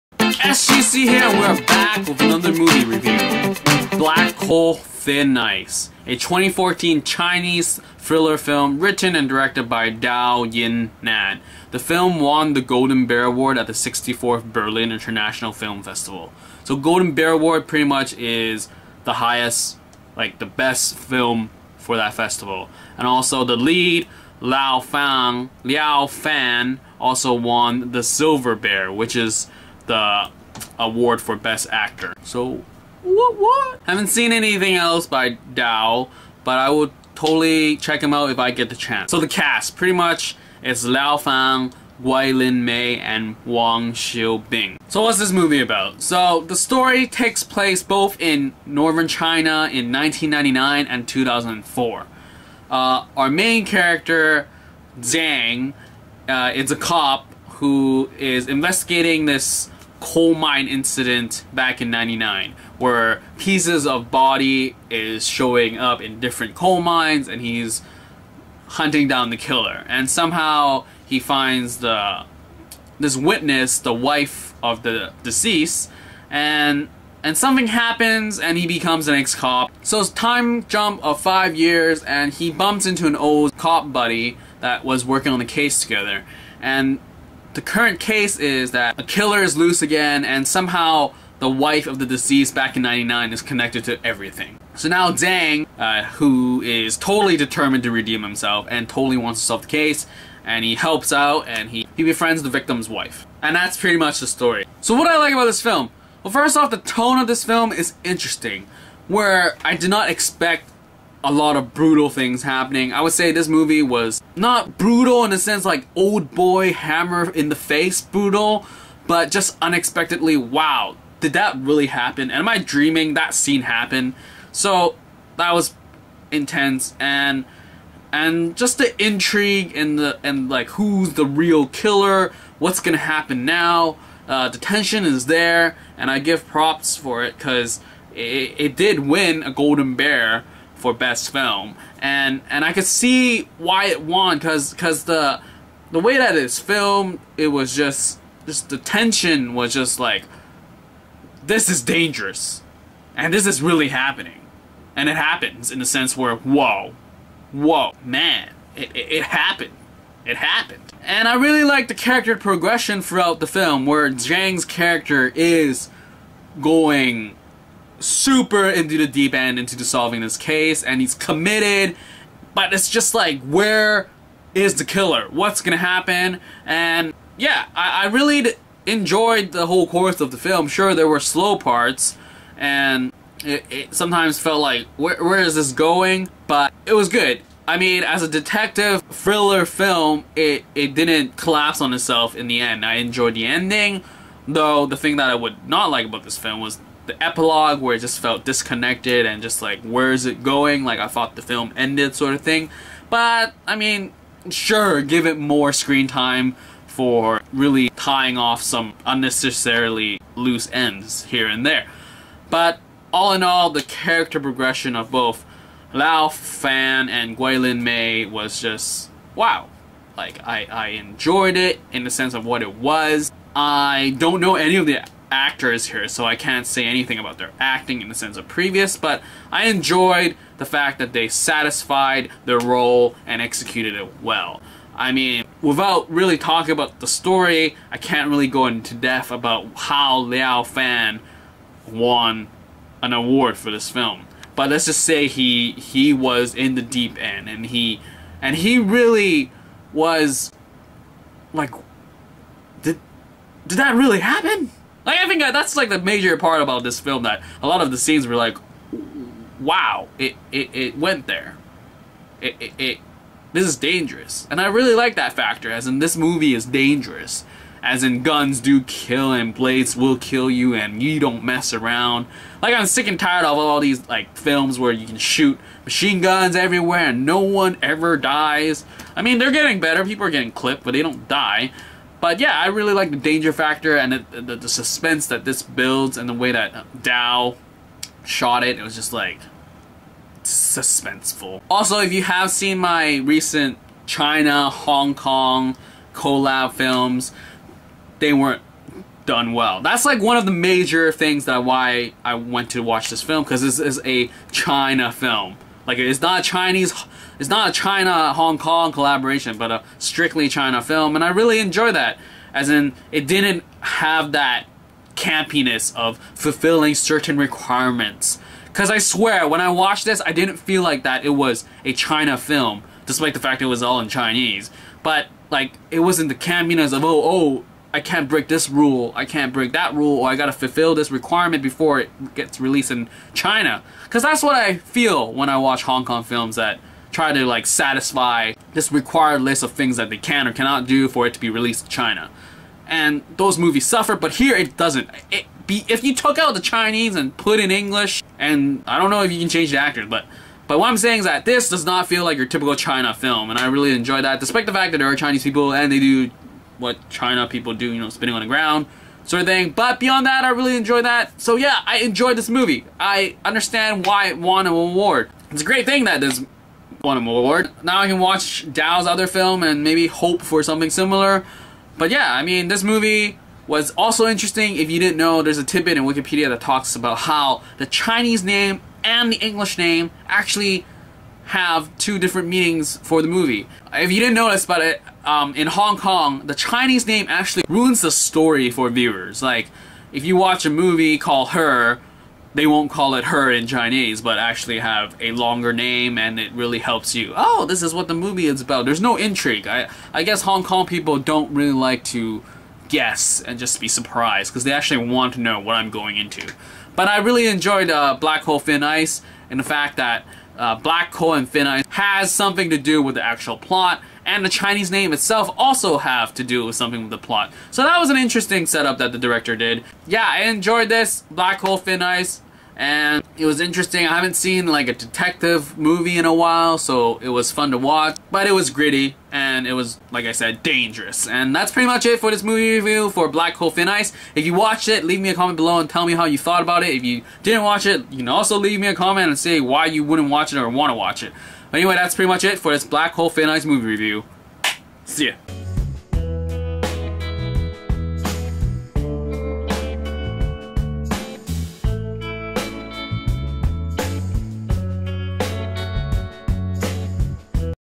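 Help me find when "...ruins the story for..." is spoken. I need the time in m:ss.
6:27.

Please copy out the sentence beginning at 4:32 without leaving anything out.
Like I'm sick and tired of all these like films where you can shoot machine guns everywhere and no one ever dies.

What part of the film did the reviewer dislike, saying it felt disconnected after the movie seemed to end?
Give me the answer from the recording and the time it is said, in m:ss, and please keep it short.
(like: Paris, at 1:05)
The epilogue, at 3:17.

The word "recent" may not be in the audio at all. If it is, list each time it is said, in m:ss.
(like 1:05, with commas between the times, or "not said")
4:53.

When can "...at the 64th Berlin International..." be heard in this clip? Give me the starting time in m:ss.
0:13.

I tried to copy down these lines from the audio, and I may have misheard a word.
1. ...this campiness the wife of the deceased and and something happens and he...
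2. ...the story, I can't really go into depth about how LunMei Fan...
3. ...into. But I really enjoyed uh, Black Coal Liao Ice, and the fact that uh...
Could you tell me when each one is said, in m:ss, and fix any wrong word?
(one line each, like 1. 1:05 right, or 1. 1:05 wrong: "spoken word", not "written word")
1. 1:12 wrong: "witness", not "campiness"
2. 3:56 wrong: "Liao", not "LunMei"
3. 6:46 wrong: "Thin", not "Liao".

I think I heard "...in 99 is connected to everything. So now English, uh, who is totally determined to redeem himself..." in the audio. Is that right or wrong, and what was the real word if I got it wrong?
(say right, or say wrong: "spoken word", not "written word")
wrong: "Zhang", not "English".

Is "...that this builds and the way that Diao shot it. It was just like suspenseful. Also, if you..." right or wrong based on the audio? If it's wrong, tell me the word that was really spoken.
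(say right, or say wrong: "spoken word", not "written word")
right.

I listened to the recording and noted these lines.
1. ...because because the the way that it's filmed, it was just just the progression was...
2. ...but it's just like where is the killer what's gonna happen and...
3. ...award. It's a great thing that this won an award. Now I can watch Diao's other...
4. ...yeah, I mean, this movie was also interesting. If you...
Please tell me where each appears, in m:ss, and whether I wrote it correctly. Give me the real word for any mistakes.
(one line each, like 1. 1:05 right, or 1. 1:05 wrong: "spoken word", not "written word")
1. 2:24 wrong: "tension", not "progression"
2. 2:52 right
3. 6:04 right
4. 6:12 right.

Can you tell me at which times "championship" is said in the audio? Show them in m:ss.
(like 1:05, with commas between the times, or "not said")
not said.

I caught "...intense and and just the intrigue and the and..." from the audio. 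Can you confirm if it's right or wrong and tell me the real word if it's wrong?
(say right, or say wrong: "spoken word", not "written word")
right.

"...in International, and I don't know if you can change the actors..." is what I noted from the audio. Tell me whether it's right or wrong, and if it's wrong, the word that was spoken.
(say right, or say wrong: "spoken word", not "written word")
wrong: "English", not "International".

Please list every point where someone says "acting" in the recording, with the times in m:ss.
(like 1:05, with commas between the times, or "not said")
3:47.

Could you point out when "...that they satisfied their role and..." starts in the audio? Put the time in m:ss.
3:50.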